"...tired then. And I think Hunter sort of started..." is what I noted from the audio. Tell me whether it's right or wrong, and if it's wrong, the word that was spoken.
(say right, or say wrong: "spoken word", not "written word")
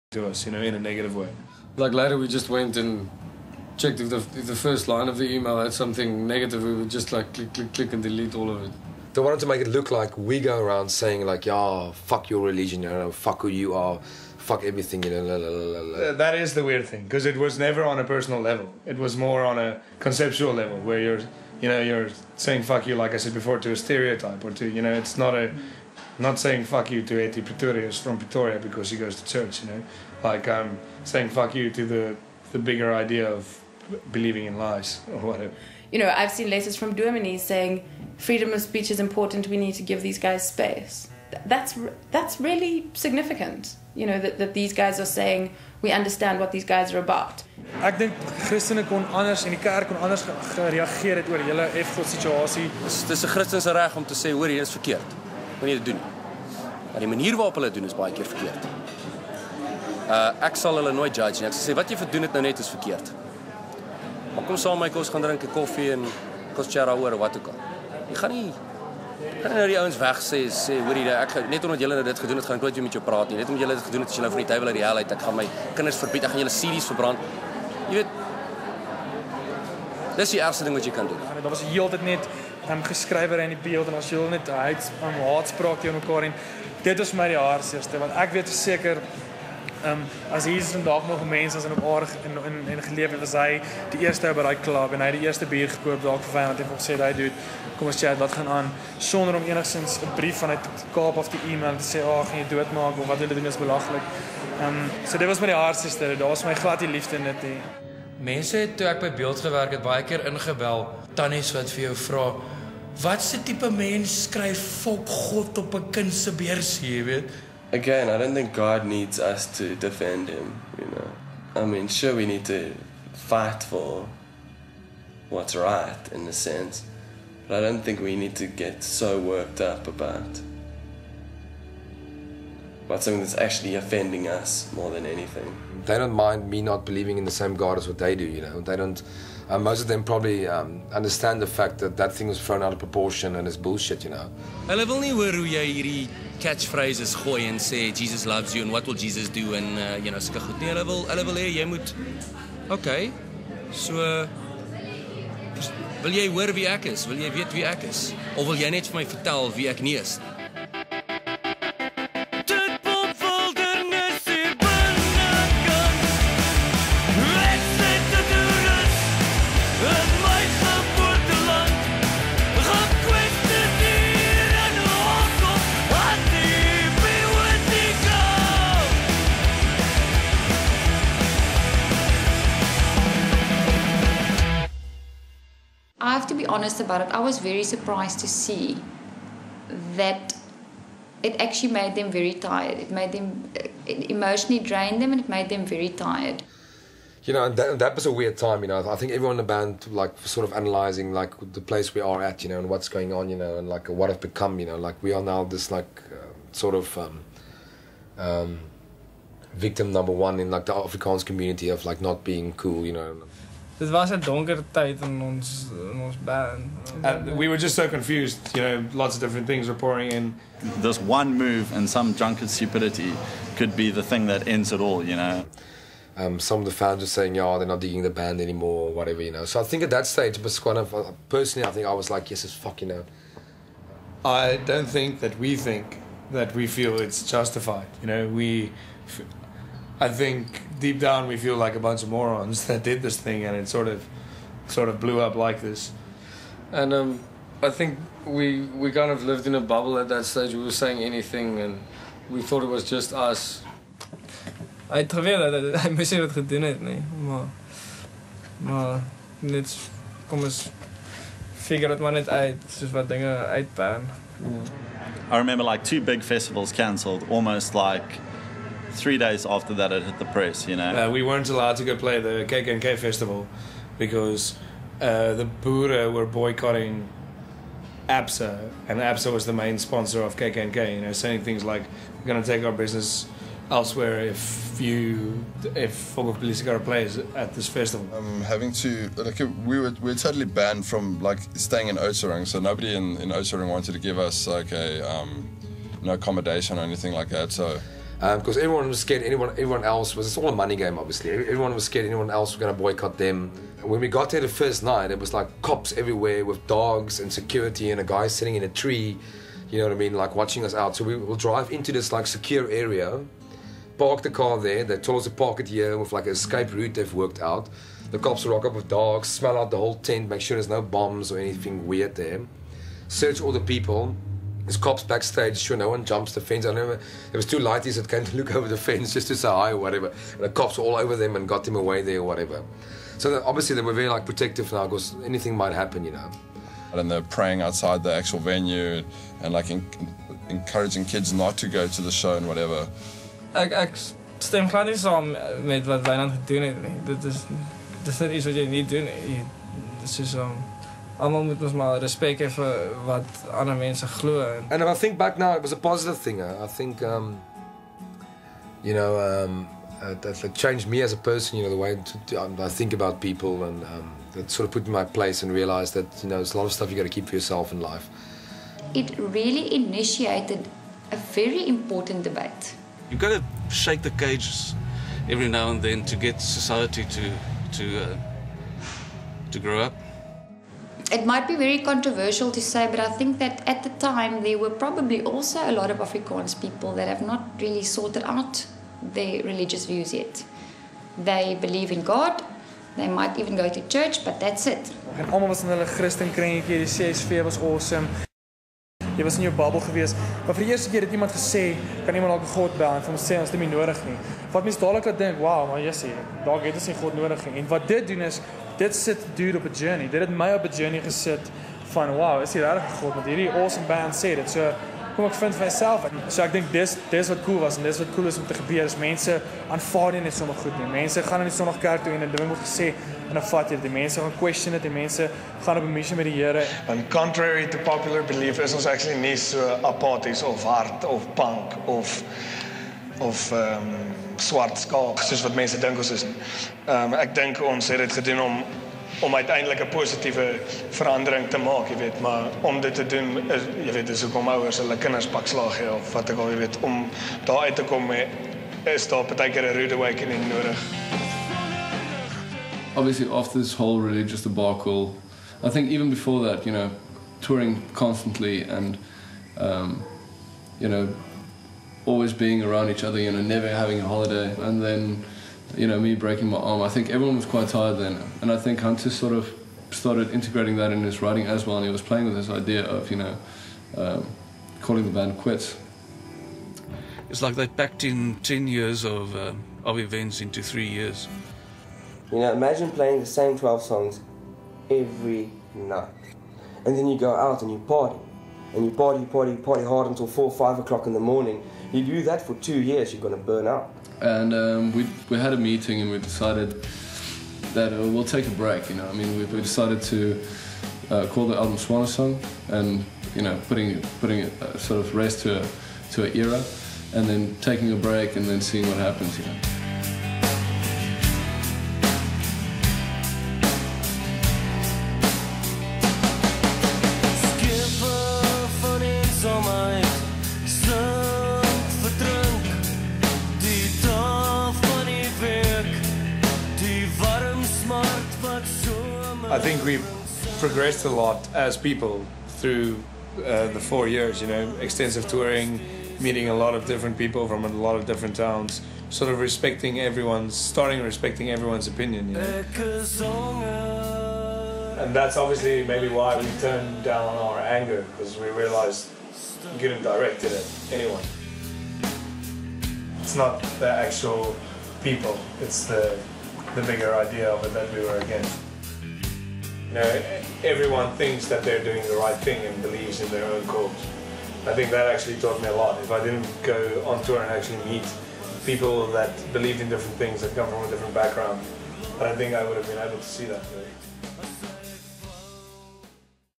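right.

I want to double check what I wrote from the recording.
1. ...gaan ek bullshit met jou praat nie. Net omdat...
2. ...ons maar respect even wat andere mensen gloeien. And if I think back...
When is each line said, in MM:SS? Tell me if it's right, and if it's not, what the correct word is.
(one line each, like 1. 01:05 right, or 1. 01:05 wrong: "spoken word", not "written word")
1. 01:12 wrong: "nooit", not "bullshit"
2. 05:51 right.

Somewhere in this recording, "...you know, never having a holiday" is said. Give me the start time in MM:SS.
07:43.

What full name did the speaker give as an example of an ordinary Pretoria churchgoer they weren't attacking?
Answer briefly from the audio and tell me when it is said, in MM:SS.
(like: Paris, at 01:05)
Eti Pretorius, at 00:27.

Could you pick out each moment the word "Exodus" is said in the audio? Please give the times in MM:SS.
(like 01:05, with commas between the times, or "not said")
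not said.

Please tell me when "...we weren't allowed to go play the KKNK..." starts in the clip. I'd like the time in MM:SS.
04:31.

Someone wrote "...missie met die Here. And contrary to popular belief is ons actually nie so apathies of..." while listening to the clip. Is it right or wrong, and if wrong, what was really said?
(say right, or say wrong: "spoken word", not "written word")
right.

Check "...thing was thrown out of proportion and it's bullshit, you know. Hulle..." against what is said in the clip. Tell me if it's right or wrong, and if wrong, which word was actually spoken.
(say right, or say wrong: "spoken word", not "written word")
right.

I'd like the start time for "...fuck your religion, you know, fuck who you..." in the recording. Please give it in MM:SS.
00:11.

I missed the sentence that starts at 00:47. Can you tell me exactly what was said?
Ek dink Christene kon anders en die kerk kon anders gereageer het oor julle F-God situasie.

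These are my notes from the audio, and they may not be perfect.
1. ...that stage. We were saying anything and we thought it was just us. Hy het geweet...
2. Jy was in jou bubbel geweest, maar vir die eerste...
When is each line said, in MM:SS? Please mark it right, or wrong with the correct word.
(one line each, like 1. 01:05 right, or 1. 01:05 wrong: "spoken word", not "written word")
1. 04:10 right
2. 06:39 right.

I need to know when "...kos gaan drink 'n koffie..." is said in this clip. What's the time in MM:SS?
01:04.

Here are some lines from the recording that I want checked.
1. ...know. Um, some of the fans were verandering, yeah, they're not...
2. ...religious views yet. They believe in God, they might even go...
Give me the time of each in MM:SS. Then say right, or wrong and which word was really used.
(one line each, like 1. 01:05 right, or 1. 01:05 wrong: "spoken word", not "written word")
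1. 03:45 wrong: "saying", not "verandering"
2. 06:29 right.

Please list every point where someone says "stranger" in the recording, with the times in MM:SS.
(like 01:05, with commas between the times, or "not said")
not said.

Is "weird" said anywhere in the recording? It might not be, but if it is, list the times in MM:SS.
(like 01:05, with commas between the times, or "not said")
00:16, 03:18, 05:21.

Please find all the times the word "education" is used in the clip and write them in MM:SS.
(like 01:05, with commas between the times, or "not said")
not said.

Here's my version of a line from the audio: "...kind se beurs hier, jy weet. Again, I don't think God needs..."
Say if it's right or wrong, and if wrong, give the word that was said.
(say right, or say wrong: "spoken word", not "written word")
right.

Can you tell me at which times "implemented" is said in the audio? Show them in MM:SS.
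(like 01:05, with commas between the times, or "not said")
not said.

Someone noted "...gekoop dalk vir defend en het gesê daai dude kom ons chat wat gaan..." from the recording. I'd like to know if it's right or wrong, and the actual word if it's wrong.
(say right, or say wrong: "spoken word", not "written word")
wrong: "vyand", not "defend".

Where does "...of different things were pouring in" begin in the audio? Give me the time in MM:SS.
03:39.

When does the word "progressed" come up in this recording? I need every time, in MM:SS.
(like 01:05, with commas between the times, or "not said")
08:50.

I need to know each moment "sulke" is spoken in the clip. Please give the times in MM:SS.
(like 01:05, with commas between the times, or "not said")
02:30.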